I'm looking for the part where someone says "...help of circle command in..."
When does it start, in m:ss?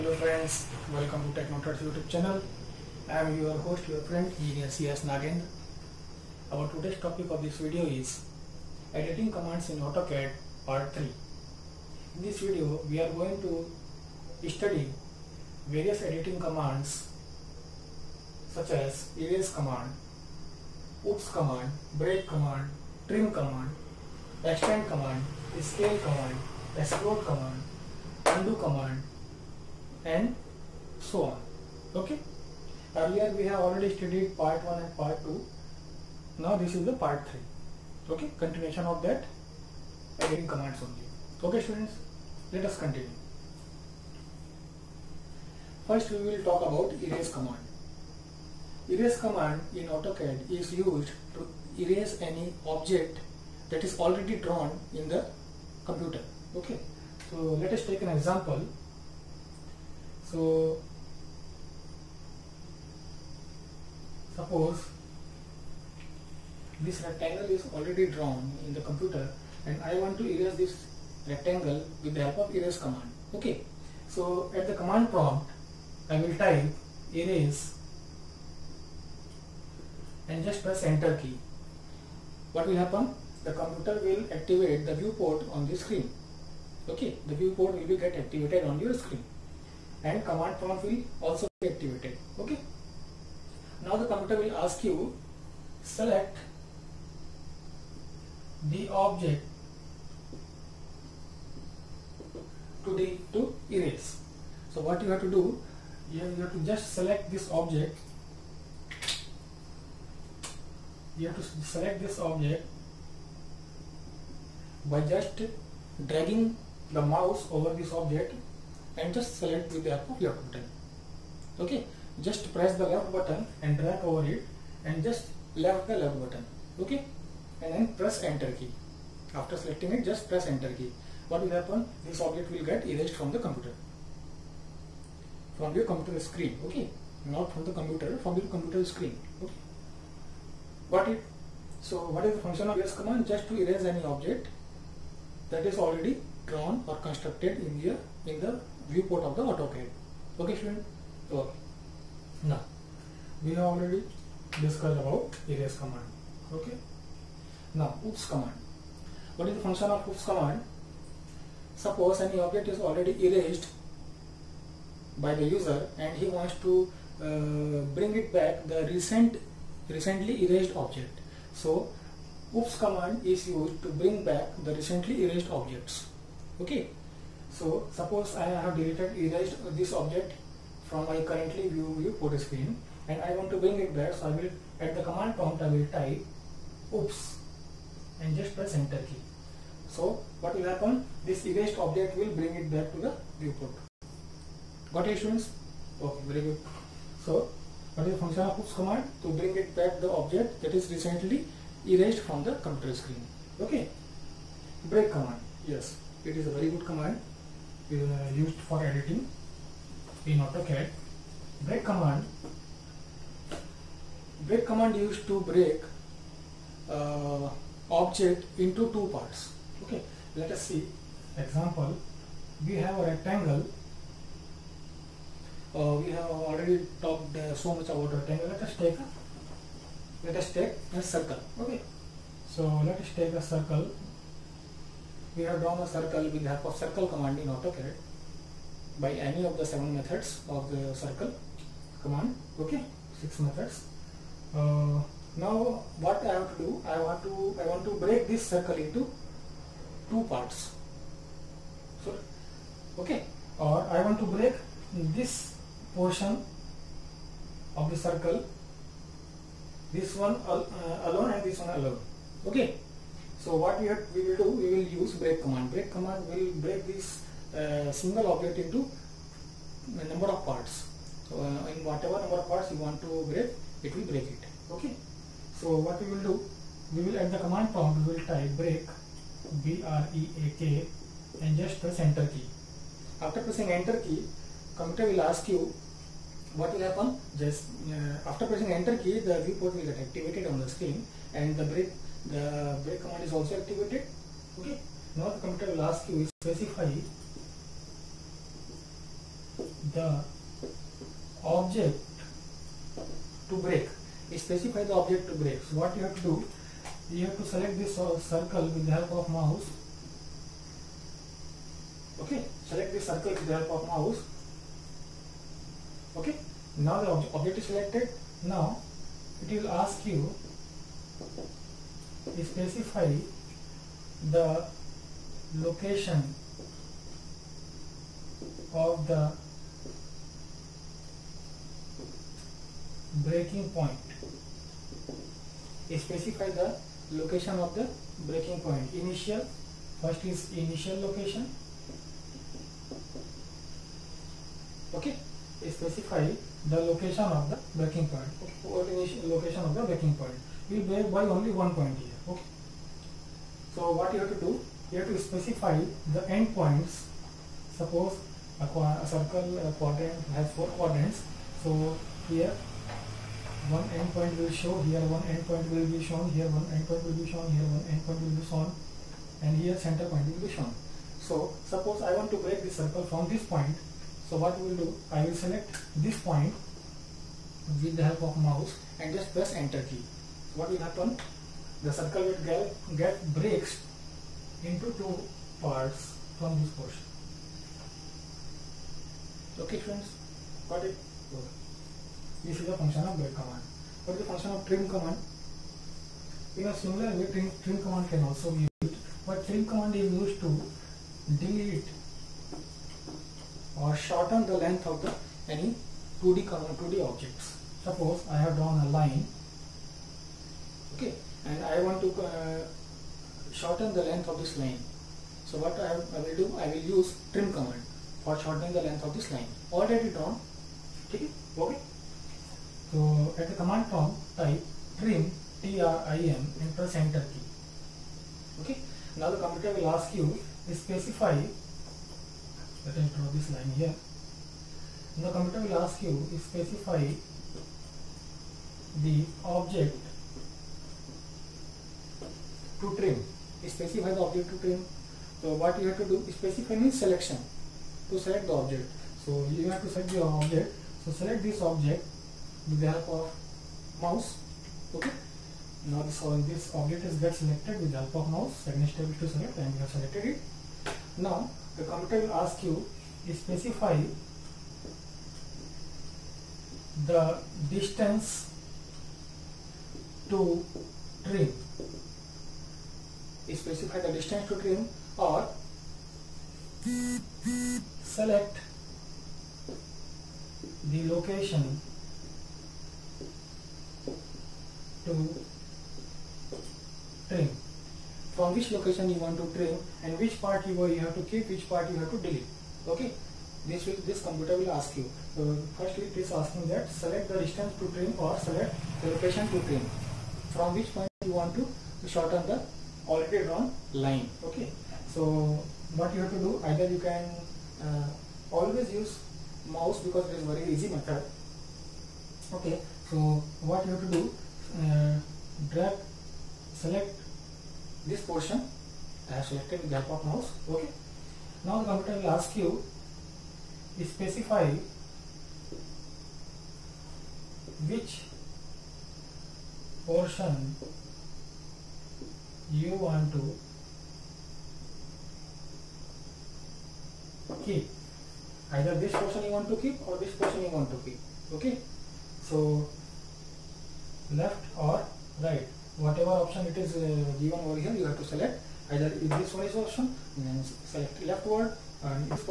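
3:56.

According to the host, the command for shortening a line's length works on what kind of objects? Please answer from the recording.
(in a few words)
2D objects.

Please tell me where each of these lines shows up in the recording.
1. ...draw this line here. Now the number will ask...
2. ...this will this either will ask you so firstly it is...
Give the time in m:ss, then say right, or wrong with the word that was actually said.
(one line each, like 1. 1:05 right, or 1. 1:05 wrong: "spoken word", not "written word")
1. 7:13 wrong: "computer", not "number"
2. 8:13 wrong: "computer", not "either".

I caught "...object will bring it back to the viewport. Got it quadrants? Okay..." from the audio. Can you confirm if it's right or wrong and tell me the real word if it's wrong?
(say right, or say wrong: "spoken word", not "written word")
wrong: "students", not "quadrants".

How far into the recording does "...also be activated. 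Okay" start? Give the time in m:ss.
1:31.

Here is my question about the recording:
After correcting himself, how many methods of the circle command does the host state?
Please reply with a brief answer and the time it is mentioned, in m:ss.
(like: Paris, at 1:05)
6, at 4:03.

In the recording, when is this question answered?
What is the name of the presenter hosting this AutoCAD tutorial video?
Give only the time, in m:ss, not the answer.
0:04.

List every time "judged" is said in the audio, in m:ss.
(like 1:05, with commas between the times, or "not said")
not said.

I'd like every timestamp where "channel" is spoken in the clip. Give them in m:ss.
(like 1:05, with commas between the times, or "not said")
0:02.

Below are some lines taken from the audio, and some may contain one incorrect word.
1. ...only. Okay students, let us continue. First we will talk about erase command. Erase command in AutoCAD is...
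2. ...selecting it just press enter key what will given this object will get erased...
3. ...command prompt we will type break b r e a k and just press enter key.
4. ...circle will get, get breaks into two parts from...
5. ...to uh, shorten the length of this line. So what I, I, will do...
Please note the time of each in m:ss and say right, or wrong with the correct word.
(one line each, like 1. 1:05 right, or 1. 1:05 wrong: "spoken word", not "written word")
1. 0:40 right
2. 2:09 wrong: "happen", not "given"
3. 4:37 right
4. 6:21 right
5. 6:51 right.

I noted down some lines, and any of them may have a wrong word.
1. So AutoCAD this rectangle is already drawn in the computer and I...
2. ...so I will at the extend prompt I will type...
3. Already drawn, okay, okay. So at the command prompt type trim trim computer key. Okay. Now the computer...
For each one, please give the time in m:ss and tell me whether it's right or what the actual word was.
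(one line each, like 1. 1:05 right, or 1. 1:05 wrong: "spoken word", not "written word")
1. 1:00 wrong: "Suppose", not "AutoCAD"
2. 3:04 wrong: "command", not "extend"
3. 6:59 wrong: "enter", not "computer".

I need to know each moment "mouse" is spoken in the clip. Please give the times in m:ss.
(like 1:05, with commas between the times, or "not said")
1:57, 5:09, 5:13, 6:18, 7:34, 7:38, 8:29, 8:40.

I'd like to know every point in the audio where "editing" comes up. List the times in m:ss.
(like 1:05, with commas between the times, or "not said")
0:08, 0:16, 3:28.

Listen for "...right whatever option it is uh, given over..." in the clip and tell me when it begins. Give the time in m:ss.
9:05.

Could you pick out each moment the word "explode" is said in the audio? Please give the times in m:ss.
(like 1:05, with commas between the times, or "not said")
0:26.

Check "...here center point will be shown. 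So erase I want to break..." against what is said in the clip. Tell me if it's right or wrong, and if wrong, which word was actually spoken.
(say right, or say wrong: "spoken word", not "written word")
wrong: "suppose", not "erase".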